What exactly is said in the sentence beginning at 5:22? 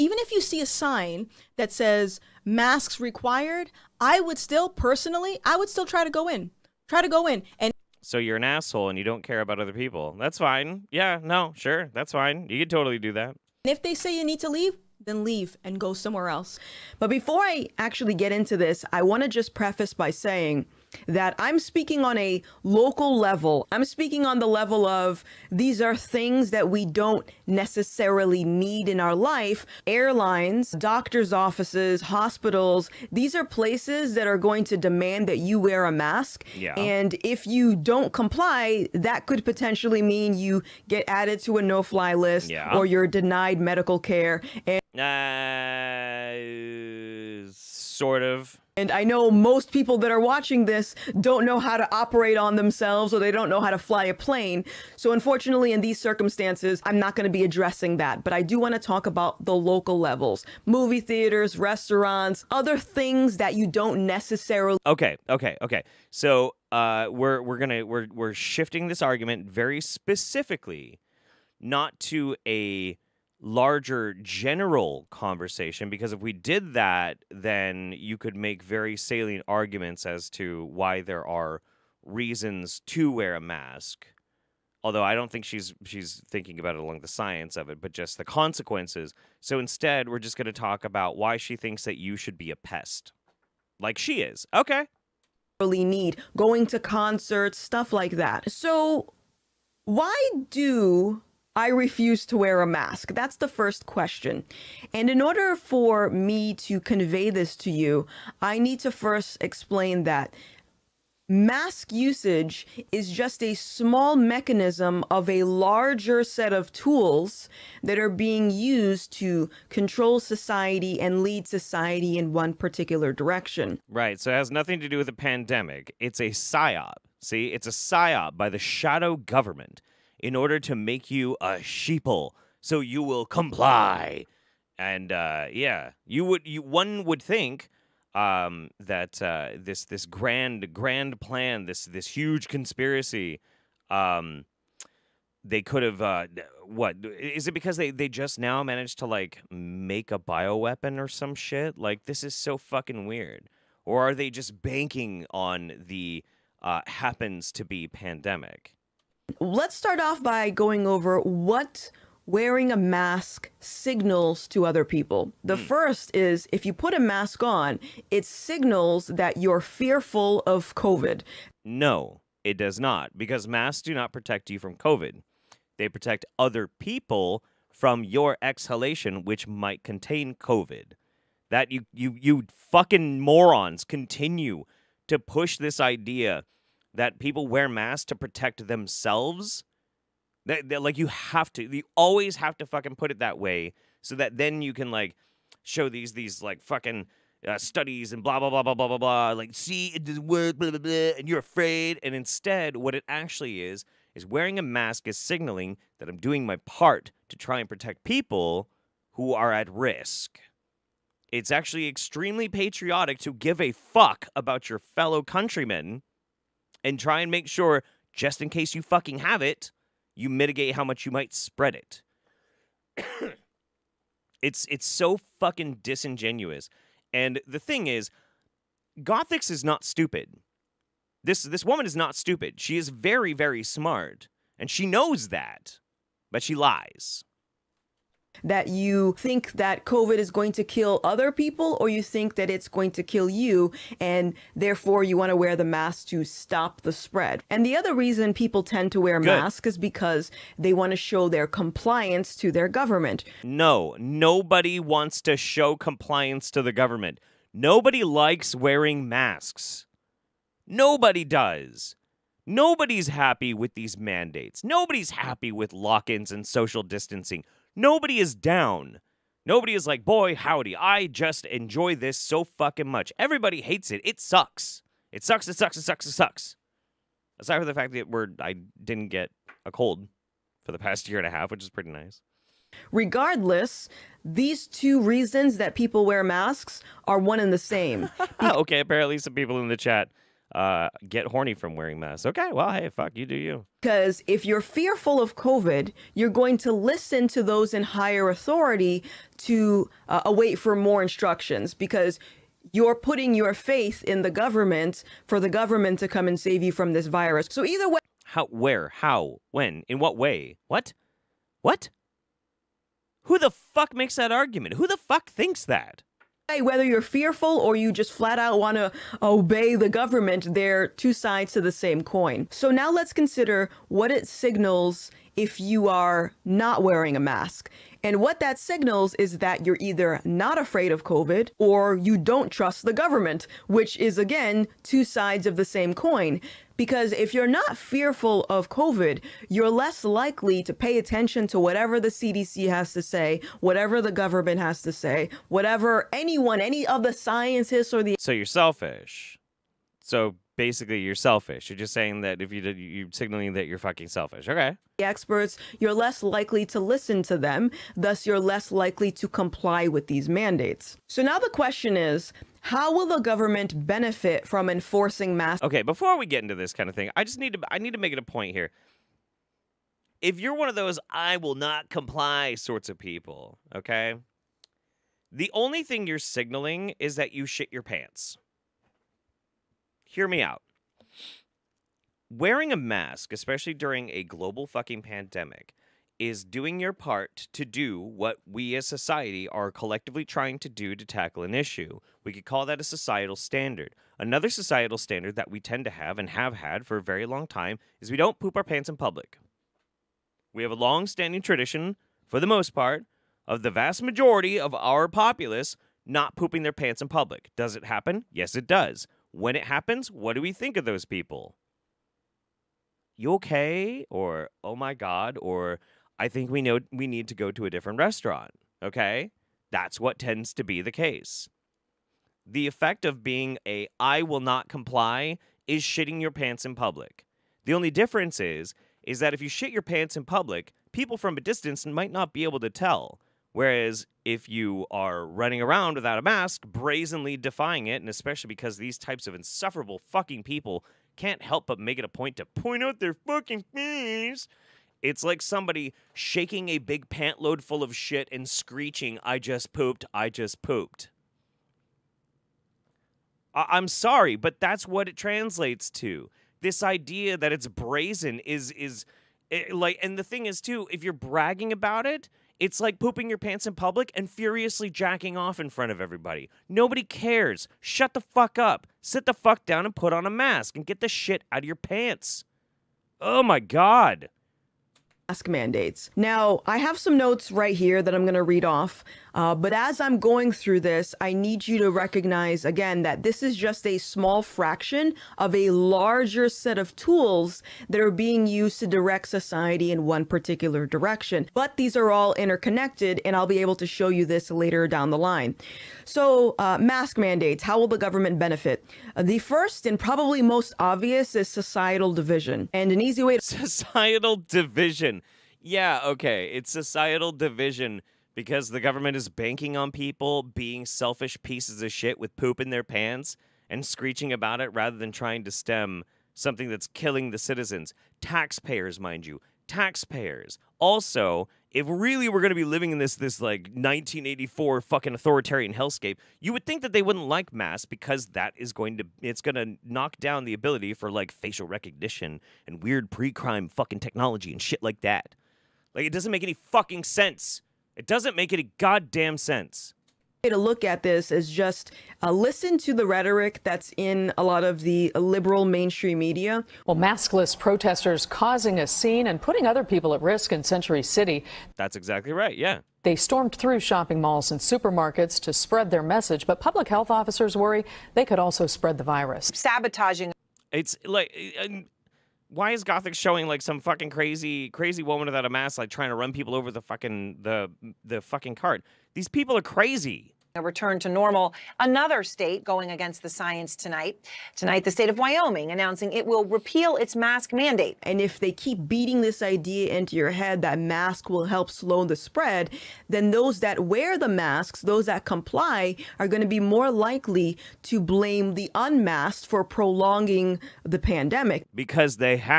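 So now let's consider what it signals if you are not wearing a mask.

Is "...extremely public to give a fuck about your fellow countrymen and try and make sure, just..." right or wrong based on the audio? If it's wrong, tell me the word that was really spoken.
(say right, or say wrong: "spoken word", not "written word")
wrong: "patriotic", not "public".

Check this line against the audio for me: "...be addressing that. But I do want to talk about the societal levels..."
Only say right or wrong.
wrong.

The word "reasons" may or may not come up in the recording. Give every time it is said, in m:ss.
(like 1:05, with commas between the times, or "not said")
1:22, 4:07, 4:45.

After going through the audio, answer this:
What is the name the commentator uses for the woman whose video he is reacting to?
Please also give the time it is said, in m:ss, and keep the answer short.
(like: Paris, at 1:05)
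Gothix, at 3:48.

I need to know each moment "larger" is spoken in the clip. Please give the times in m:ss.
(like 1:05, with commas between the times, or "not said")
1:13, 1:55, 8:05.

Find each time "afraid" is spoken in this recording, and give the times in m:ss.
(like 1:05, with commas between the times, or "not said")
3:21, 5:30.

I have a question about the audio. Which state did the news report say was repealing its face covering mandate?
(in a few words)
Wyoming.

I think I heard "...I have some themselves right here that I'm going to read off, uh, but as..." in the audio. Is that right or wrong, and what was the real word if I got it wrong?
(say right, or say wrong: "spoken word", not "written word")
wrong: "notes", not "themselves".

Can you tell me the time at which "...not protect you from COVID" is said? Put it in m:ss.
2:53.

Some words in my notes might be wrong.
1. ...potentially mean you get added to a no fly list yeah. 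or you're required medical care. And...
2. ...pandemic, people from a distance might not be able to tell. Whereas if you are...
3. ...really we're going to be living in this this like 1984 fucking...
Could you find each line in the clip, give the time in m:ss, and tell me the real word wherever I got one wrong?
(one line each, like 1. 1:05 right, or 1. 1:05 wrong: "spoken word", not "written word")
1. 0:39 wrong: "denied", not "required"
2. 7:10 wrong: "public", not "pandemic"
3. 8:41 right.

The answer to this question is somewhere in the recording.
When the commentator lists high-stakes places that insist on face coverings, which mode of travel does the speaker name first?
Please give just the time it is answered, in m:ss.
0:29.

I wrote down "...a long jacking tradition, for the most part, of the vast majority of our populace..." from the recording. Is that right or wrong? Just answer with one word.
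wrong.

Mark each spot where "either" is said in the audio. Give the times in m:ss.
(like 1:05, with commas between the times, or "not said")
5:07, 5:29.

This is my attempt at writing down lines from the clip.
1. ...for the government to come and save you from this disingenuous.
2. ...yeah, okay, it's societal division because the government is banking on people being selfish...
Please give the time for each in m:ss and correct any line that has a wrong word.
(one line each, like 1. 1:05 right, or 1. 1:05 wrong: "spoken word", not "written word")
1. 5:05 wrong: "virus", not "disingenuous"
2. 8:25 right.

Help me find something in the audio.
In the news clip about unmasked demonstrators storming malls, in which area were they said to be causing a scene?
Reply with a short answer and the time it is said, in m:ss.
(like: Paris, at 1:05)
Century City, at 9:10.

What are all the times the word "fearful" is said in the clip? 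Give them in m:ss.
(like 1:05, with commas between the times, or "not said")
2:49, 4:54, 5:17, 5:37.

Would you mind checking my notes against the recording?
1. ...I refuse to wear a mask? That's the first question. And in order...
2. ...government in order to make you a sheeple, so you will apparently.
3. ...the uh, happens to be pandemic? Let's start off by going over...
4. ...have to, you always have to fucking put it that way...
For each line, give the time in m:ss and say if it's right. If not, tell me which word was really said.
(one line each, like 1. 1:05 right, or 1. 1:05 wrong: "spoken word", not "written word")
1. 1:41 right
2. 2:09 wrong: "comply", not "apparently"
3. 2:35 right
4. 3:11 right.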